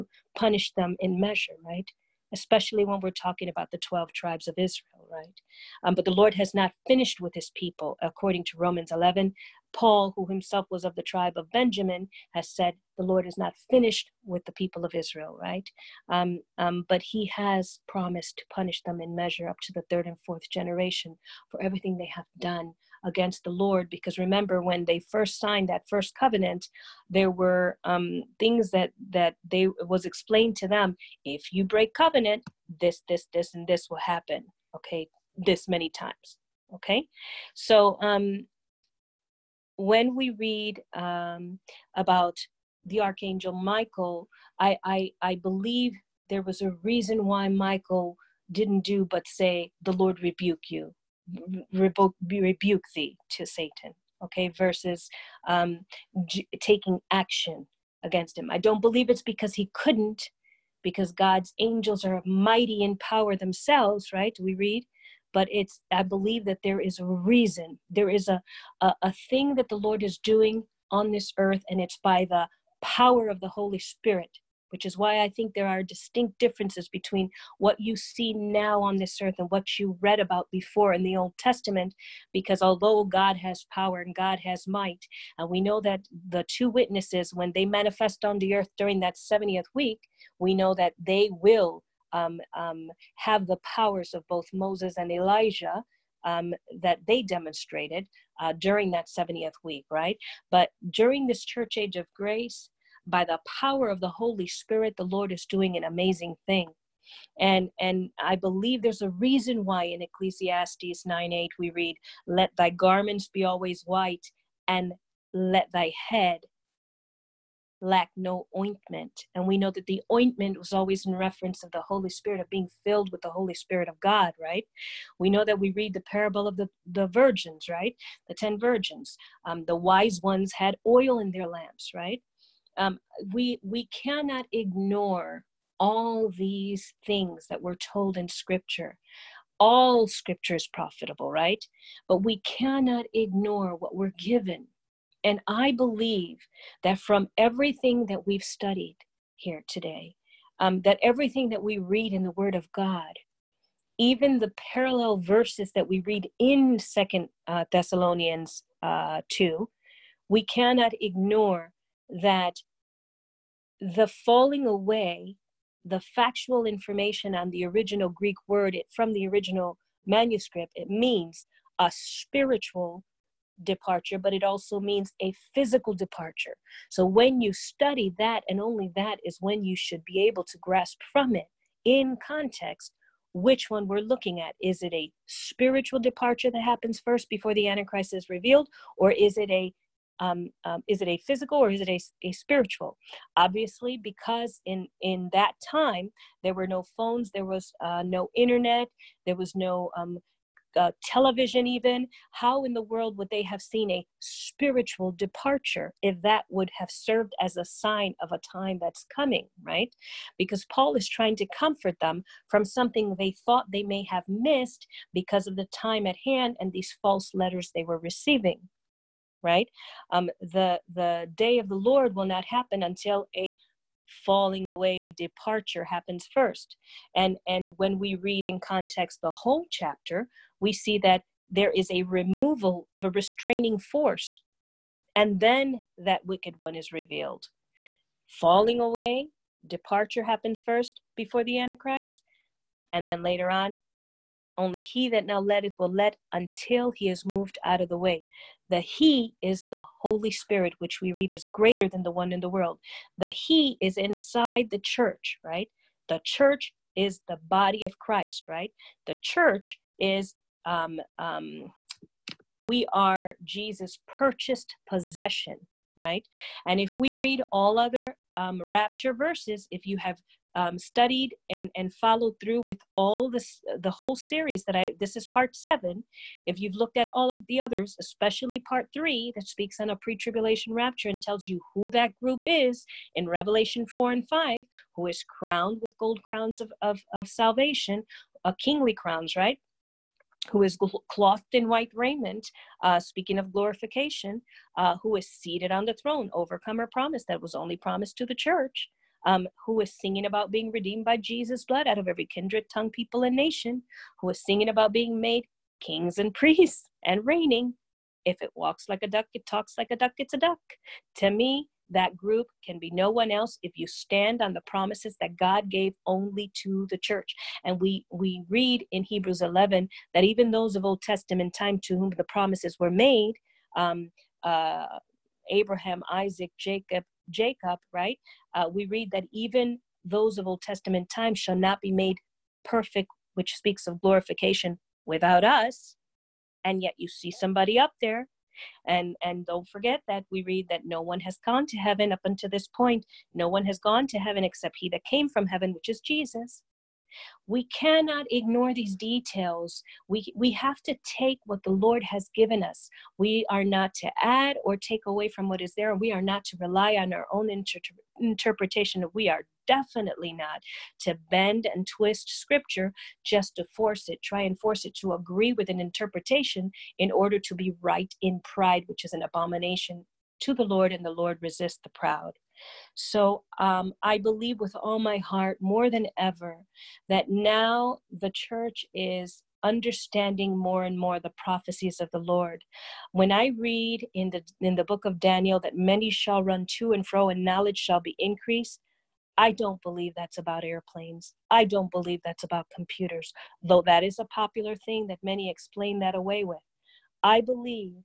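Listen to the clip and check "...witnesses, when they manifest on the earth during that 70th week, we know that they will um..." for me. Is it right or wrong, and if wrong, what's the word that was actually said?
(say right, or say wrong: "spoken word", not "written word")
right.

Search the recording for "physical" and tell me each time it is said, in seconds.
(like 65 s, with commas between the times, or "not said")
175 s, 191 s.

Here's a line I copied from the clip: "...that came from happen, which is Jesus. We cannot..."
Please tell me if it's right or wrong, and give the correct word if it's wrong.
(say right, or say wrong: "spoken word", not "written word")
wrong: "heaven", not "happen".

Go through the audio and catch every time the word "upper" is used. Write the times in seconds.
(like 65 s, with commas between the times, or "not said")
not said.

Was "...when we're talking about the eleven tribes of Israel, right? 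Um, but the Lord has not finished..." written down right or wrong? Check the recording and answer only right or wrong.
wrong.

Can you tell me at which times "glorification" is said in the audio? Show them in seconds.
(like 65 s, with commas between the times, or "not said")
293 s, 334 s.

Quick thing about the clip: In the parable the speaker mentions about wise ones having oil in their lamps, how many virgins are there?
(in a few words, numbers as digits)
10.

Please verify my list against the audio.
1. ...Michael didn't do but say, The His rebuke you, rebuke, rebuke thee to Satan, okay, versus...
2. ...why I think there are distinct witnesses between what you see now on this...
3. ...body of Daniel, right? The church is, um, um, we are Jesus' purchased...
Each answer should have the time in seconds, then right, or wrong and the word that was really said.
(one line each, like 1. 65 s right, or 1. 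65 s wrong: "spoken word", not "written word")
1. 47 s wrong: "Lord", not "His"
2. 74 s wrong: "differences", not "witnesses"
3. 257 s wrong: "Christ", not "Daniel".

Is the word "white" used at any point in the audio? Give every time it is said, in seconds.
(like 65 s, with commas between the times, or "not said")
113 s, 291 s.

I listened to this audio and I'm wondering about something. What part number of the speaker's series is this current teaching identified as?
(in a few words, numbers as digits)
7.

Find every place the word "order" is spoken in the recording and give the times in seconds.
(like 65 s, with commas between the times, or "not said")
367 s.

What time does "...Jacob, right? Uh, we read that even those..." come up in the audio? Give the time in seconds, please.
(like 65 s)
327 s.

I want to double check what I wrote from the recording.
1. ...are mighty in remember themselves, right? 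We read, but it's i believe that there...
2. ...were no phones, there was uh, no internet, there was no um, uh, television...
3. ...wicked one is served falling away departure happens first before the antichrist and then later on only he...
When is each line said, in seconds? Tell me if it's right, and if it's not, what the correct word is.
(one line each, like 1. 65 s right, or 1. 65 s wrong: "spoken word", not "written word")
1. 62 s wrong: "power", not "remember"
2. 196 s right
3. 236 s wrong: "revealed", not "served".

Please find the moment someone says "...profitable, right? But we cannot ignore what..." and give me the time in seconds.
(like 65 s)
140 s.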